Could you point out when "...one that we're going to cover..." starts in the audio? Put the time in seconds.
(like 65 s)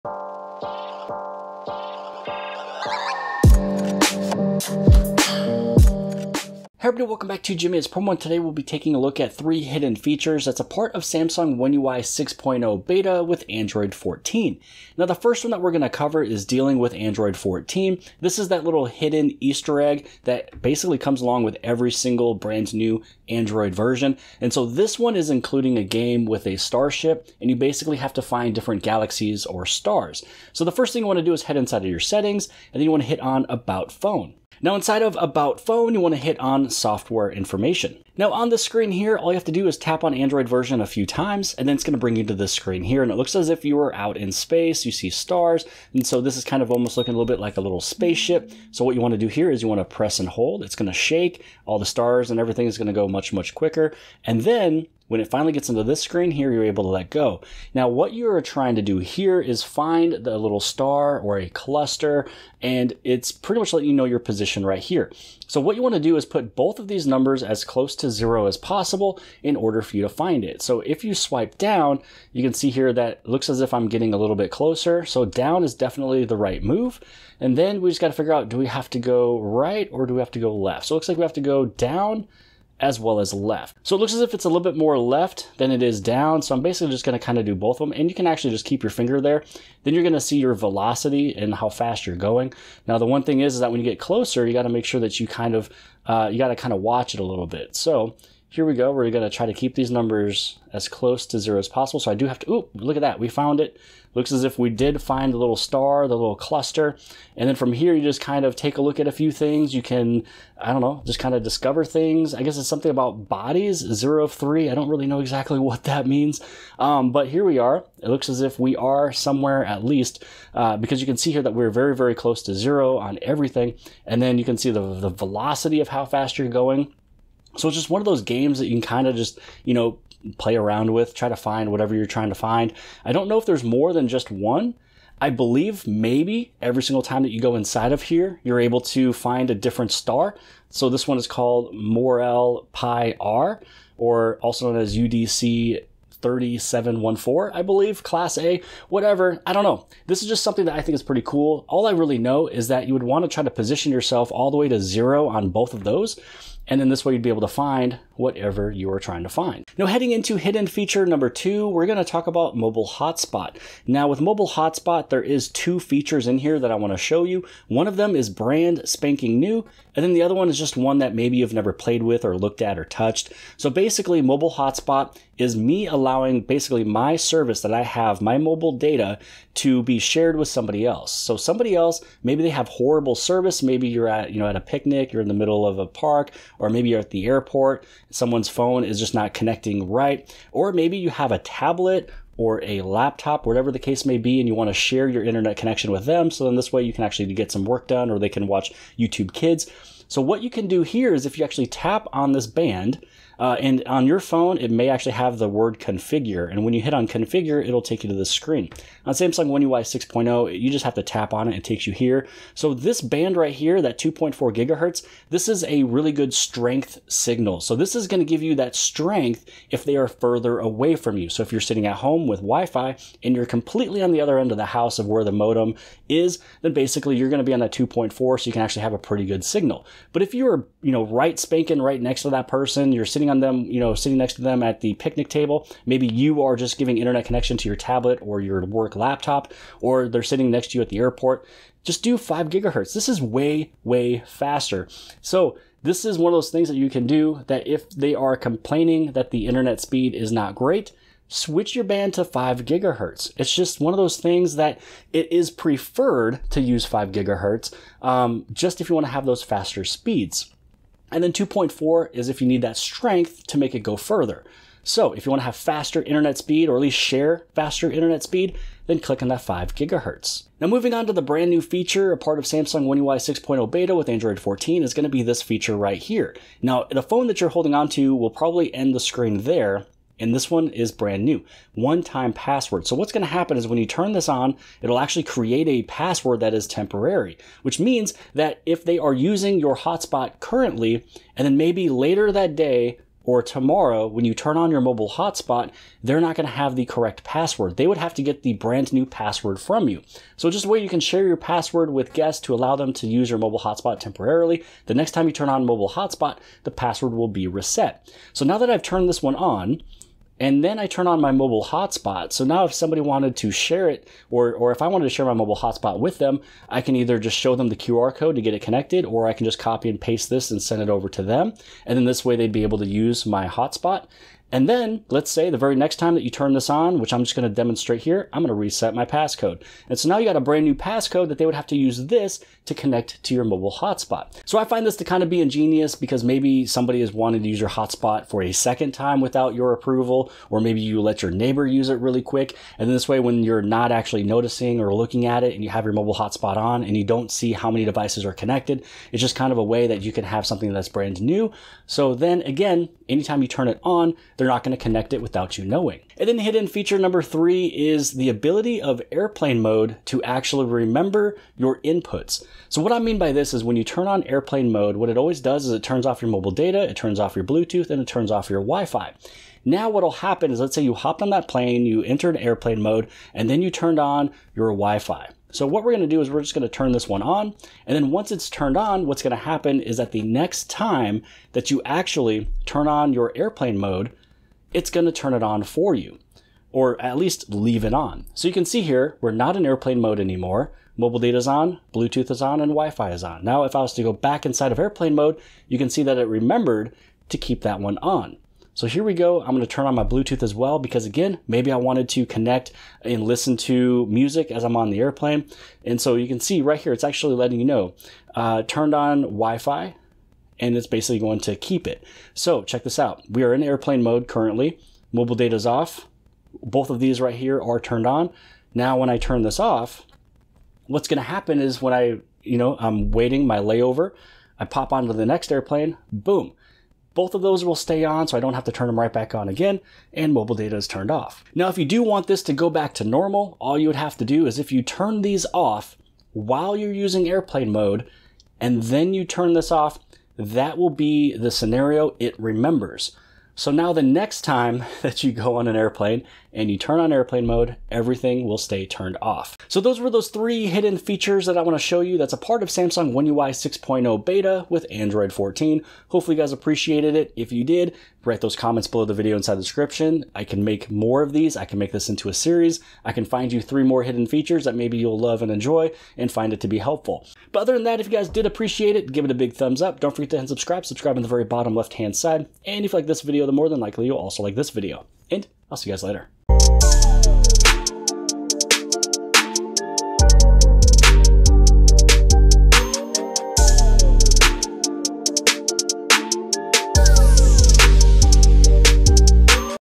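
15 s.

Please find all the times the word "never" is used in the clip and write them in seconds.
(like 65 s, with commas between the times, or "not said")
171 s.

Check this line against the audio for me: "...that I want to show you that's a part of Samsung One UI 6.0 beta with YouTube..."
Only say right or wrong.
wrong.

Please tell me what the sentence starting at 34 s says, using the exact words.
Now inside of About Phone, you want to hit on Software Information.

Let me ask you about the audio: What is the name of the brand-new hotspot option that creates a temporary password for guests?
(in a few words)
One time password.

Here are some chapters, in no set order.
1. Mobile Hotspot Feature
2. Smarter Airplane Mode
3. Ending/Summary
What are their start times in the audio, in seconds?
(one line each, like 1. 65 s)
1. 159 s
2. 356 s
3. 449 s.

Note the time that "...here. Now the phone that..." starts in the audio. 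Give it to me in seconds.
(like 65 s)
275 s.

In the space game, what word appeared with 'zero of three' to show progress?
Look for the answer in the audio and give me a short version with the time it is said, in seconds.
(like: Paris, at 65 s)
bodies, at 113 s.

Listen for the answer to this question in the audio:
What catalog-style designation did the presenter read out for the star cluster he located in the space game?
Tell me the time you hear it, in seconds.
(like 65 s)
144 s.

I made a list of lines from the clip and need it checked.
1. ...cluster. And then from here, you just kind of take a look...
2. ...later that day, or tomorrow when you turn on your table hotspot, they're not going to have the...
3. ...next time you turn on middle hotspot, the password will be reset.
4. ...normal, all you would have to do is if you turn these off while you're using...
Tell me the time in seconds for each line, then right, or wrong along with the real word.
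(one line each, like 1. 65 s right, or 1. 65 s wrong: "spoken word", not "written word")
1. 106 s right
2. 291 s wrong: "mobile", not "table"
3. 304 s wrong: "mobile", not "middle"
4. 433 s right.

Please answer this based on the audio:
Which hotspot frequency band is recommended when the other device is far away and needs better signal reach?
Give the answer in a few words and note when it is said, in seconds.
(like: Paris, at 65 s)
2.4 gigahertz, at 213 s.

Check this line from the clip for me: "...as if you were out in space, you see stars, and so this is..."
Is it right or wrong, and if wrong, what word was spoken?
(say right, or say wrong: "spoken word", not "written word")
right.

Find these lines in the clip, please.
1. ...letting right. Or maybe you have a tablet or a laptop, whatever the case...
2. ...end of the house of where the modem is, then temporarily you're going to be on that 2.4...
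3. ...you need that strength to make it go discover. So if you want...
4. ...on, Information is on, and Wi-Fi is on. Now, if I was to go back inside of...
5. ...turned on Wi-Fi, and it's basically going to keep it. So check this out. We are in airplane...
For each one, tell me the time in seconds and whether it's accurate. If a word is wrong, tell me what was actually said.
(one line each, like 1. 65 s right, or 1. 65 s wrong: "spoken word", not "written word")
1. 189 s wrong: "connecting", not "letting"
2. 224 s wrong: "basically", not "temporarily"
3. 262 s wrong: "further", not "discover"
4. 391 s wrong: "Bluetooth", not "Information"
5. 408 s right.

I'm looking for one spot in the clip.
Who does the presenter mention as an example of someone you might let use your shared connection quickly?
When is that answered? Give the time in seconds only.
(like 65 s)
341 s.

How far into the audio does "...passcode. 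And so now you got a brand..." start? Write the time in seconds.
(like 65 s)
329 s.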